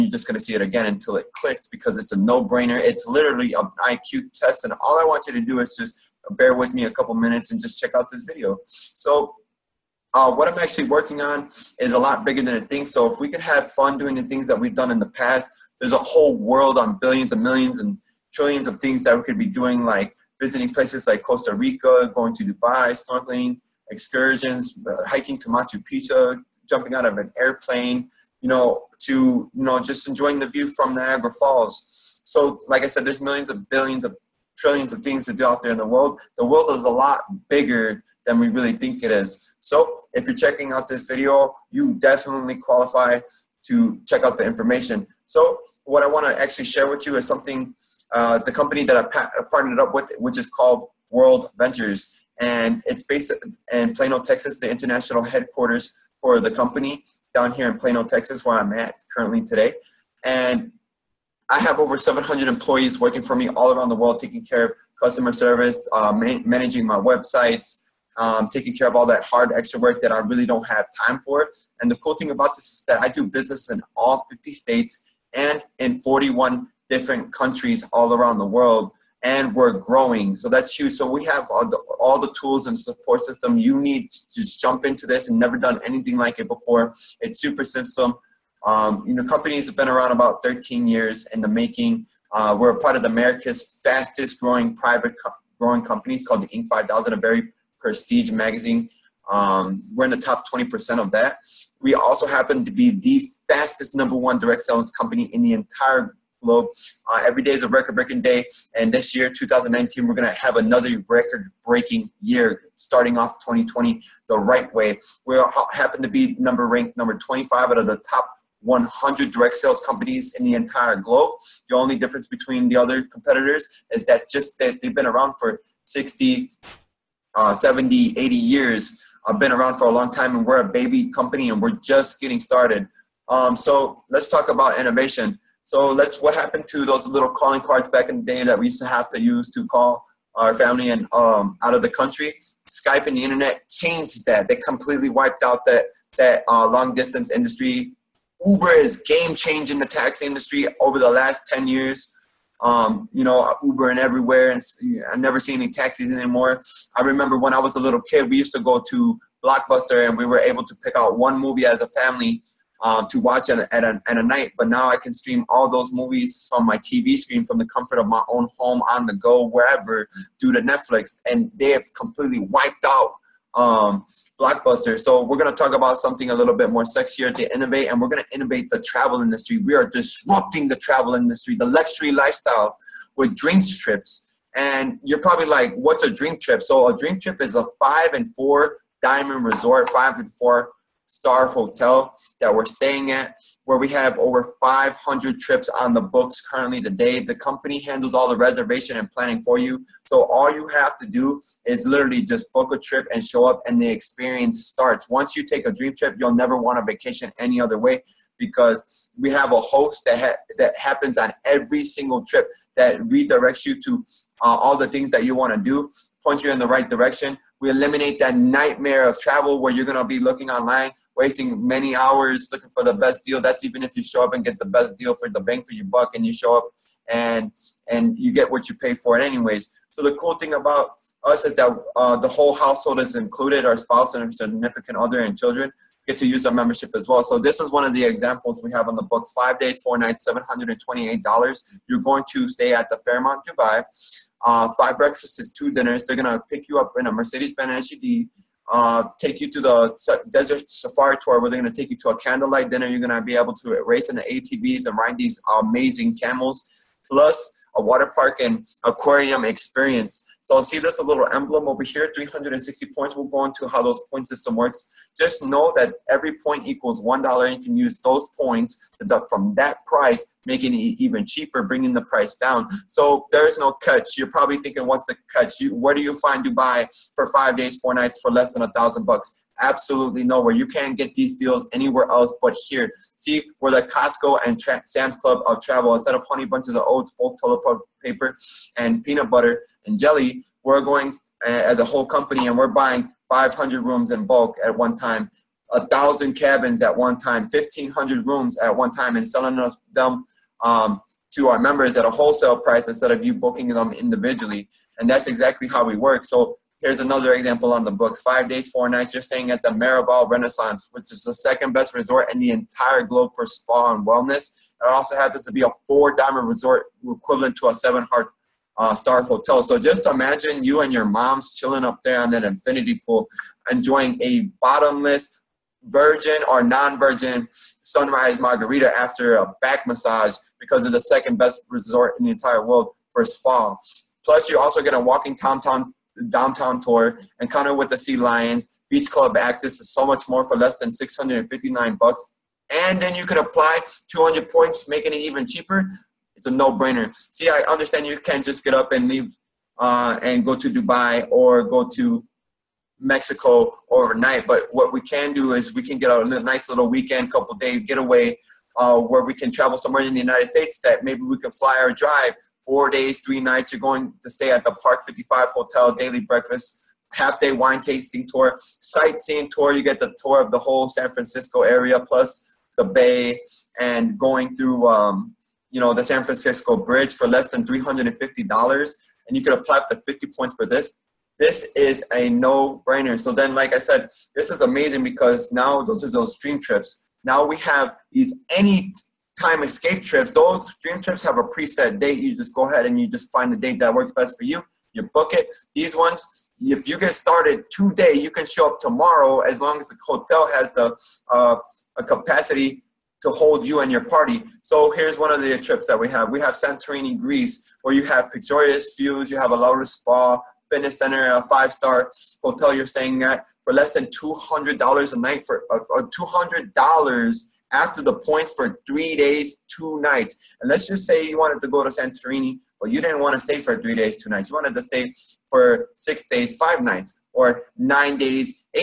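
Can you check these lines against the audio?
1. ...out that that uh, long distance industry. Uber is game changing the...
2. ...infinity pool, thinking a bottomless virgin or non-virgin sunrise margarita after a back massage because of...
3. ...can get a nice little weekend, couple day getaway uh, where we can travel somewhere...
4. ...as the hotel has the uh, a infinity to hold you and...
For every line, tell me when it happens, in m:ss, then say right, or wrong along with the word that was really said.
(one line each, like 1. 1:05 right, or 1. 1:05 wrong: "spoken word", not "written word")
1. 2:25 right
2. 5:22 wrong: "enjoying", not "thinking"
3. 5:55 right
4. 6:39 wrong: "capacity", not "infinity".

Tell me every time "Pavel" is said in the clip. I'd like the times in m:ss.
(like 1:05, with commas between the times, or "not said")
not said.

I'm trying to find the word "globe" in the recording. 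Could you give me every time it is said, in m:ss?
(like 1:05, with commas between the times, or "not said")
1:46, 2:00, 5:13.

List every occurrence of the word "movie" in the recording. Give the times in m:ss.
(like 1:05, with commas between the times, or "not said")
2:41, 2:45.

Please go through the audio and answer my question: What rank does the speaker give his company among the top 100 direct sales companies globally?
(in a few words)
25.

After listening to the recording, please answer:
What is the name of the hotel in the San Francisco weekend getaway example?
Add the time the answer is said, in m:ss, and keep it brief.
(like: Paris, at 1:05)
Park 55 Hotel, at 6:04.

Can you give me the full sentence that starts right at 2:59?
We are disrupting the travel industry, the luxury lifestyle with dream trips.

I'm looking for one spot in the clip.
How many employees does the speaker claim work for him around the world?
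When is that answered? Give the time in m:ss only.
1:01.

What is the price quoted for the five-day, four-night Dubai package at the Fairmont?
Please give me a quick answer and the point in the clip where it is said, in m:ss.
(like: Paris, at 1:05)
$728, at 4:00.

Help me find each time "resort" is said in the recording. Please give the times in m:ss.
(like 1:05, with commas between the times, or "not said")
3:09, 5:11, 5:16, 5:31.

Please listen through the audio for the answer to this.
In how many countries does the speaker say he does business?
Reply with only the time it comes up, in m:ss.
1:15.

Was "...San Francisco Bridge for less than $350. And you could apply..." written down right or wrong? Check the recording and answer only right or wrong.
right.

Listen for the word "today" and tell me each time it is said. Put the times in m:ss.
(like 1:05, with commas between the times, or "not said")
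0:59, 3:16, 6:37.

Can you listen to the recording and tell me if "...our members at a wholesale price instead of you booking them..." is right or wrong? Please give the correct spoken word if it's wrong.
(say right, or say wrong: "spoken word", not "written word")
right.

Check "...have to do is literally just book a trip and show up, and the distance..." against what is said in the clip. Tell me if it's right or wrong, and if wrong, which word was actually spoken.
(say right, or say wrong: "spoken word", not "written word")
wrong: "experience", not "distance".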